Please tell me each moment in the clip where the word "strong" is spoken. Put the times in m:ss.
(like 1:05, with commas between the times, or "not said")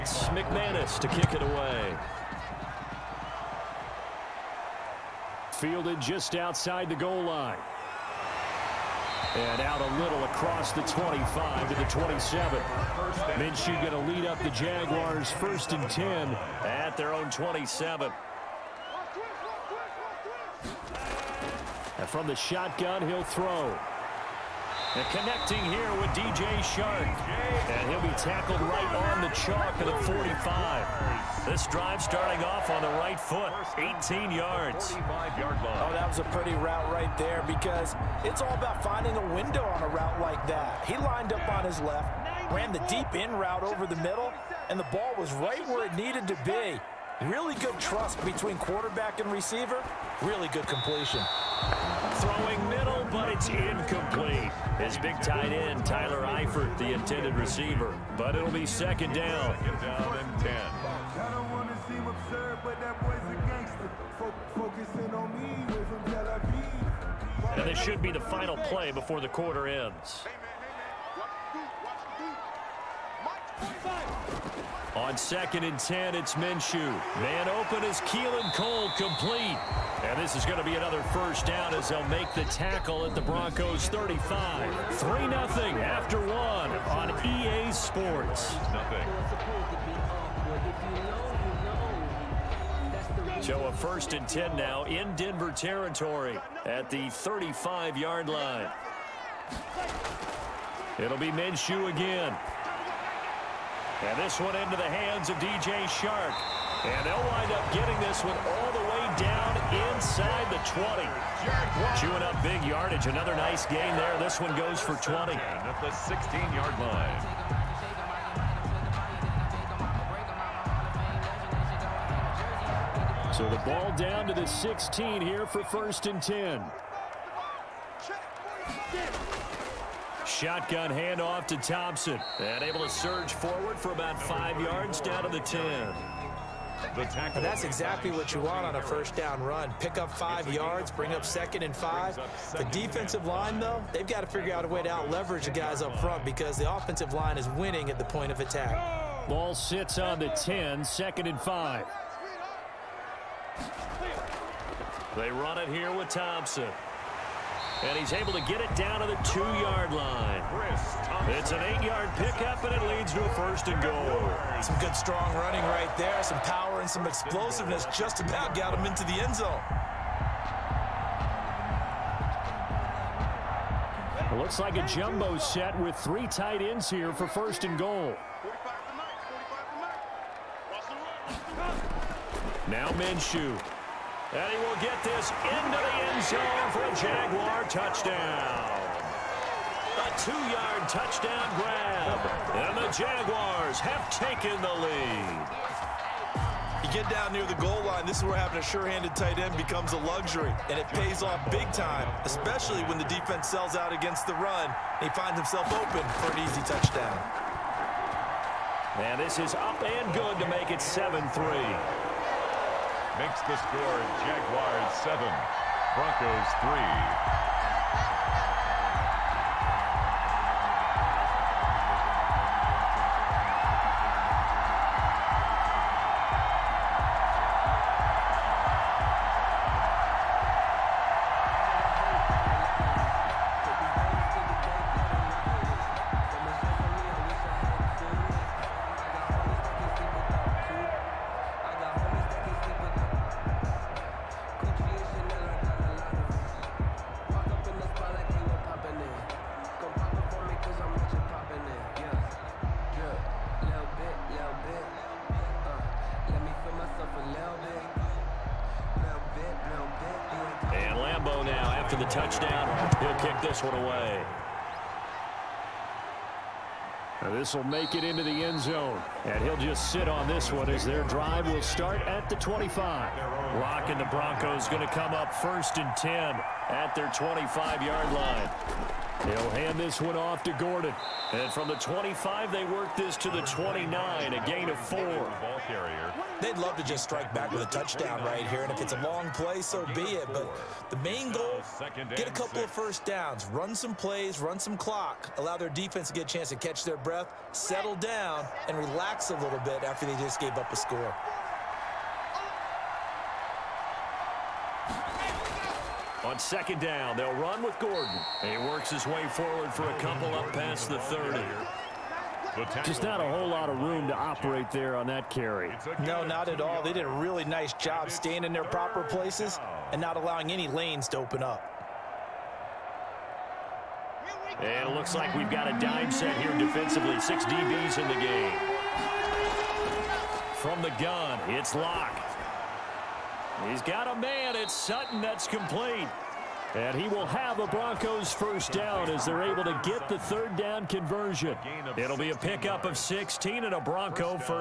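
2:44.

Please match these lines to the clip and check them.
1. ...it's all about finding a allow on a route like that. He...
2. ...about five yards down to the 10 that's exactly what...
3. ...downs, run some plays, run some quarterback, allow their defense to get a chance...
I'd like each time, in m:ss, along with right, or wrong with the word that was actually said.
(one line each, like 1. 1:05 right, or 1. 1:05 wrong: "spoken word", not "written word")
1. 0:38 wrong: "window", not "allow"
2. 2:13 right
3. 4:53 wrong: "clock", not "quarterback".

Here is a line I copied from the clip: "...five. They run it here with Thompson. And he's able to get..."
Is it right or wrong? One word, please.
right.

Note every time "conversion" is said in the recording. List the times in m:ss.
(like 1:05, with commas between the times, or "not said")
5:40.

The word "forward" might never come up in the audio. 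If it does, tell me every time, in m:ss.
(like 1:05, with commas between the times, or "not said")
2:13, 5:09.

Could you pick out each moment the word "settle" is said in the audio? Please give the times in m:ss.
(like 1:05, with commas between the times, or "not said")
4:57.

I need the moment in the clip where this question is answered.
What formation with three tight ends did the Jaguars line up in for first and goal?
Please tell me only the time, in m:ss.
2:54.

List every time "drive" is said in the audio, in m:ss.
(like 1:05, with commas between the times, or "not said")
0:31, 4:31.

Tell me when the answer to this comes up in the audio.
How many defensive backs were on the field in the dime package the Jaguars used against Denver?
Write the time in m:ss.
5:27.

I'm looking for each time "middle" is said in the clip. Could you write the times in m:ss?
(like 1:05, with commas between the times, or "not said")
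0:43, 0:52.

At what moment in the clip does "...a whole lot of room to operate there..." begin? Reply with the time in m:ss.
5:13.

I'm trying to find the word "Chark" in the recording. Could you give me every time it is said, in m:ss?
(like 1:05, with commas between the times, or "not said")
0:26, 1:45.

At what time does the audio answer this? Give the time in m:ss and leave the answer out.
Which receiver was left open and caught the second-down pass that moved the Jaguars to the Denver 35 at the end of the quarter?
1:18.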